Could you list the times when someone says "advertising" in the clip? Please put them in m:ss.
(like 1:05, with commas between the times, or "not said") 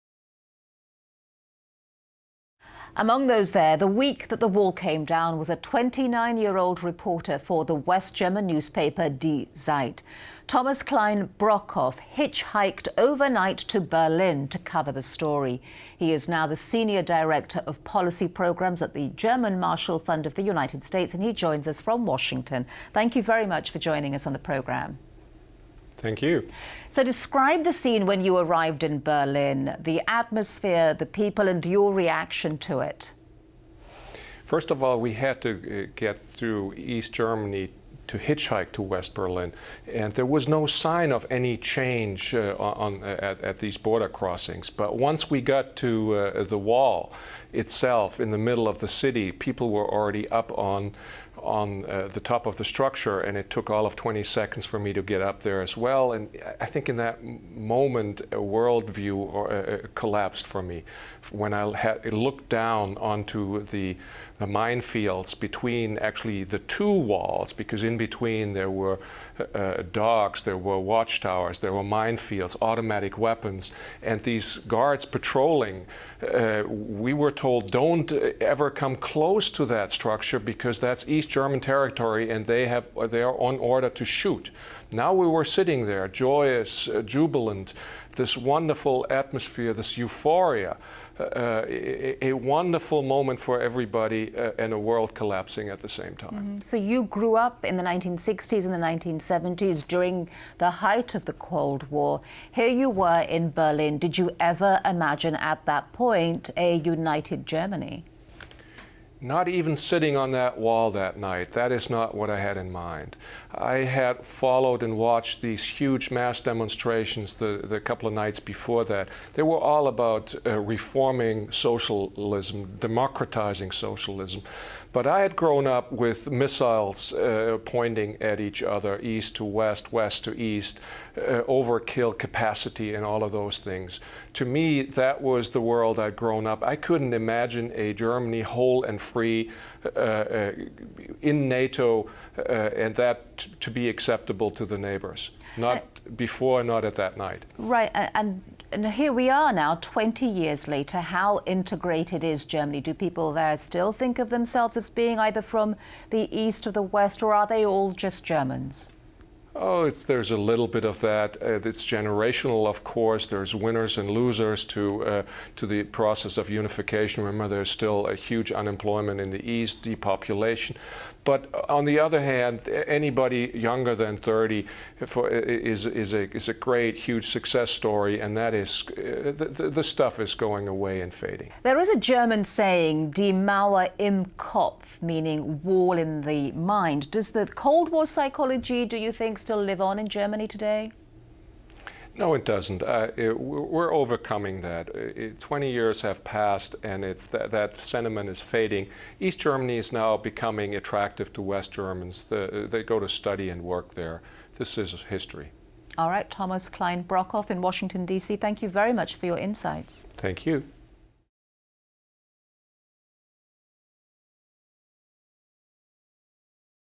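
not said.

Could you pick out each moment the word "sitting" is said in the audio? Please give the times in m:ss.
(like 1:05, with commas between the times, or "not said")
1:25, 1:49.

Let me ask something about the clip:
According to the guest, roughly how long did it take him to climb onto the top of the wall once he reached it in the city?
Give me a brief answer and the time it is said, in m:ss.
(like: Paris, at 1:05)
20 seconds, at 0:53.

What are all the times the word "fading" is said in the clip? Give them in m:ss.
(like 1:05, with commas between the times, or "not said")
3:01, 3:18.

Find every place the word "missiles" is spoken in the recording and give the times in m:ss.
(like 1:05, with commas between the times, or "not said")
2:06.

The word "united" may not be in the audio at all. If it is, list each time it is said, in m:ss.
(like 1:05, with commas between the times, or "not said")
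0:20, 1:46.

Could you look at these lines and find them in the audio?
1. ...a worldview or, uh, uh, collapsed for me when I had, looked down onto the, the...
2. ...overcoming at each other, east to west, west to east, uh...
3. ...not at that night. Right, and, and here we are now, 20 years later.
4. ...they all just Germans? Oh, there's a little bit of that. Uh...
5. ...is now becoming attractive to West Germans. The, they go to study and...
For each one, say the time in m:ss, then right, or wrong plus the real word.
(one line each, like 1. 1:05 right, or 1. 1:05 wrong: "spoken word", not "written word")
1. 0:58 right
2. 2:07 wrong: "pointing", not "overcoming"
3. 2:26 right
4. 2:37 right
5. 3:19 right.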